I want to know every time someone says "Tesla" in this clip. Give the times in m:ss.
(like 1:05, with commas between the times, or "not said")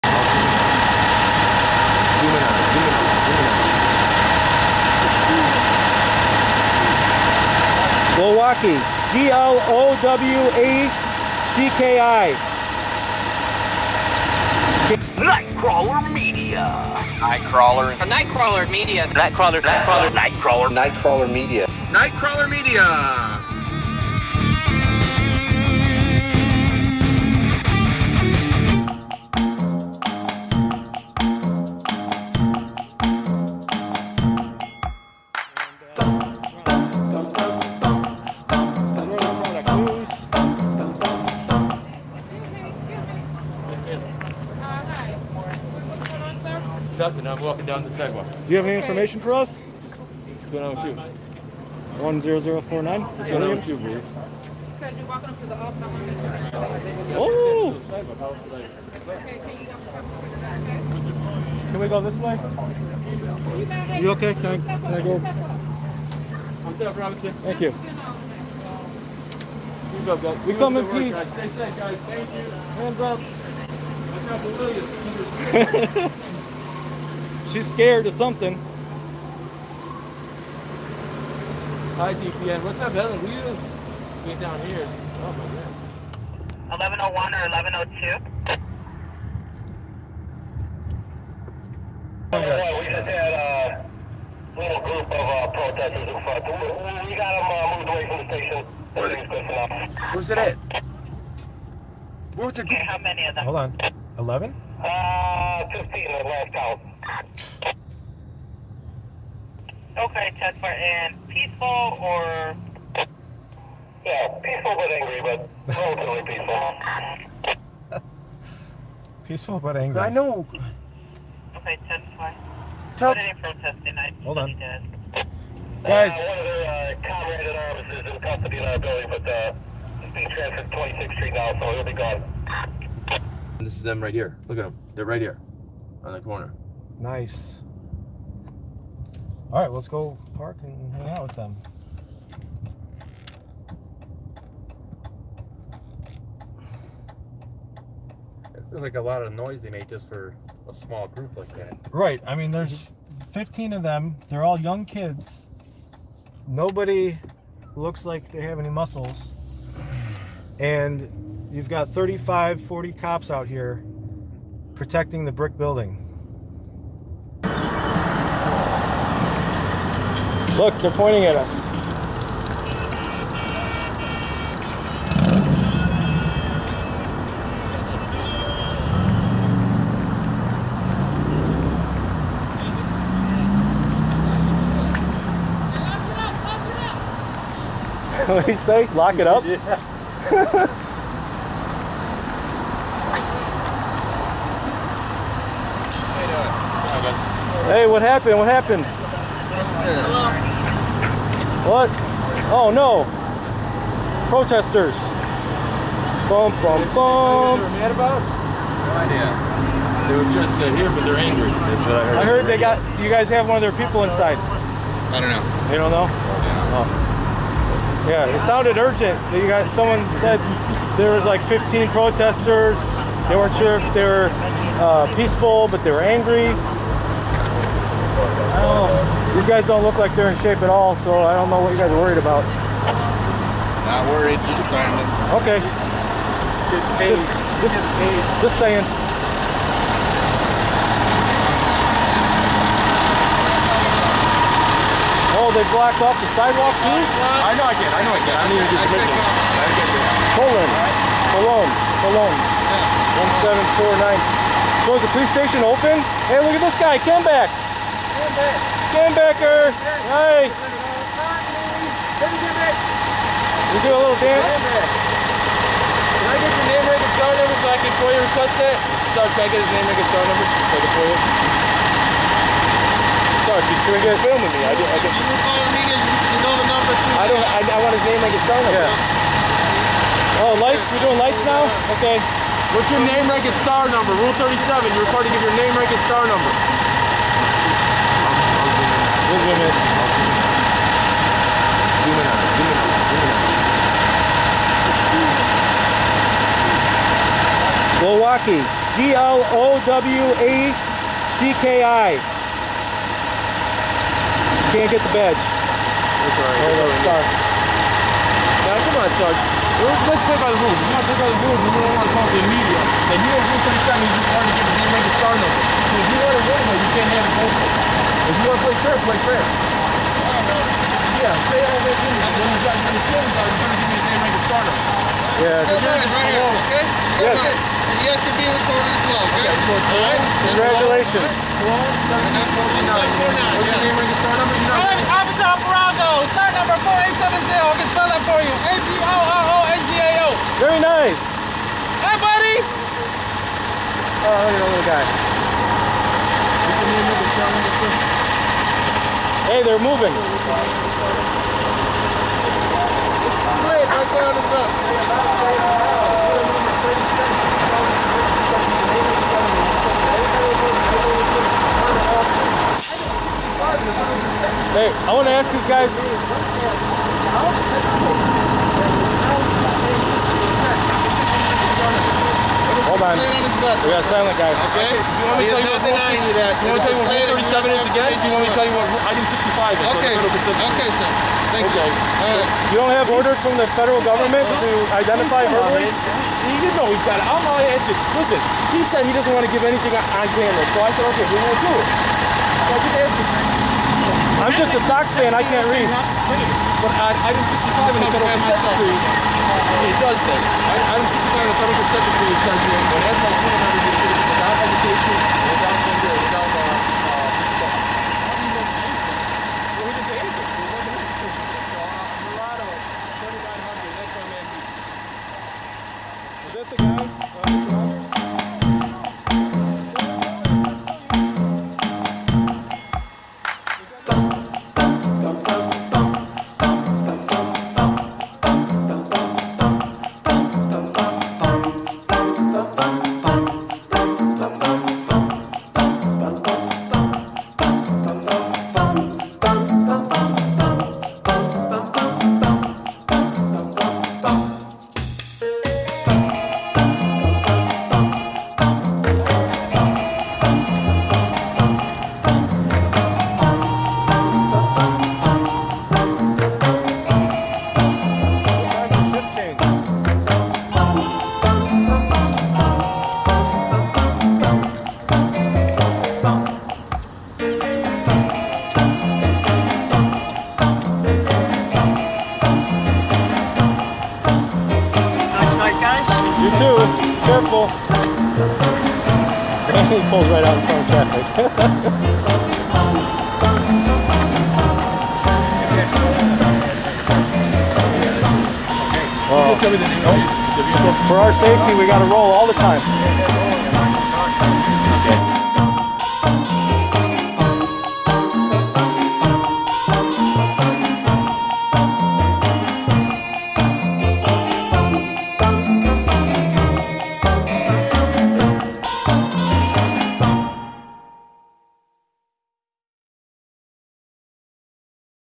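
1:50, 2:01.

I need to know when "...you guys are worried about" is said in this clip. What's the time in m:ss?
3:51.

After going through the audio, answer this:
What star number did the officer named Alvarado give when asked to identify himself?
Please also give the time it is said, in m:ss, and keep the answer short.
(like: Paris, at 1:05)
4870, at 5:36.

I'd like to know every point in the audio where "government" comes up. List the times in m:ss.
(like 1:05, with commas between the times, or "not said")
6:24.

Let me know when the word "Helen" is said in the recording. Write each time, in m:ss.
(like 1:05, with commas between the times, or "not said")
1:22.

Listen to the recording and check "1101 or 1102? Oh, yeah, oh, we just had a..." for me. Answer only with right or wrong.
right.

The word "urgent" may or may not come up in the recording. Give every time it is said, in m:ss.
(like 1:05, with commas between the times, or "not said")
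3:38.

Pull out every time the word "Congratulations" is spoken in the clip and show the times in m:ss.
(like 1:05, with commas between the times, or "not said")
5:30.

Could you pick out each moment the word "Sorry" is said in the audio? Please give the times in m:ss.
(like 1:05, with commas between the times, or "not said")
4:29, 4:33.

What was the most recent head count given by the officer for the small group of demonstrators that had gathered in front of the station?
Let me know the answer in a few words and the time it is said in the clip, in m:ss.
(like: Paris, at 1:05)
15, at 1:45.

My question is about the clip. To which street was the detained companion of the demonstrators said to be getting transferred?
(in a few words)
26th Street.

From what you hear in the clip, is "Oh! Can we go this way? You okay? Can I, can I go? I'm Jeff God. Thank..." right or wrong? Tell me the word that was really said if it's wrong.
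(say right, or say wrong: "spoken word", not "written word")
wrong: "Robinson", not "God".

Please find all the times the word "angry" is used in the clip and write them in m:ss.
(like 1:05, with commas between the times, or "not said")
1:54, 1:59, 3:31, 3:46.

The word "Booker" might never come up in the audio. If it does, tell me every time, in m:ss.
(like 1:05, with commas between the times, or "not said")
not said.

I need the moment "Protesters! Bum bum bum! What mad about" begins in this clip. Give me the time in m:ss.
3:24.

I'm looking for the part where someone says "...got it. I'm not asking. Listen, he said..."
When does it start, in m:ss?
6:27.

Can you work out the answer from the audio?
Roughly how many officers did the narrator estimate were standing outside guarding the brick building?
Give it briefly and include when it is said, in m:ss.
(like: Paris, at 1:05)
35 to 40, at 2:41.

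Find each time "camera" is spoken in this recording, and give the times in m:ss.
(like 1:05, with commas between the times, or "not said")
6:30.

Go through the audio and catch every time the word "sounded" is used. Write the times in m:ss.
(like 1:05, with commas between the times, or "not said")
3:38.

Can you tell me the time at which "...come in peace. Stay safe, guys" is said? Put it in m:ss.
1:10.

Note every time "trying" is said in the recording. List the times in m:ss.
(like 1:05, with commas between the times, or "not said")
5:13, 5:23.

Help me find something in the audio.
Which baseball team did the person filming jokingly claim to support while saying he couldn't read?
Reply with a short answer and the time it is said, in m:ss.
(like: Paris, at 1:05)
Sox, at 6:34.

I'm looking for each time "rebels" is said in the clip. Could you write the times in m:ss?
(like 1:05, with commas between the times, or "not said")
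not said.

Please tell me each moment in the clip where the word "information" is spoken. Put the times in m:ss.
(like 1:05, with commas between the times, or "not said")
0:48.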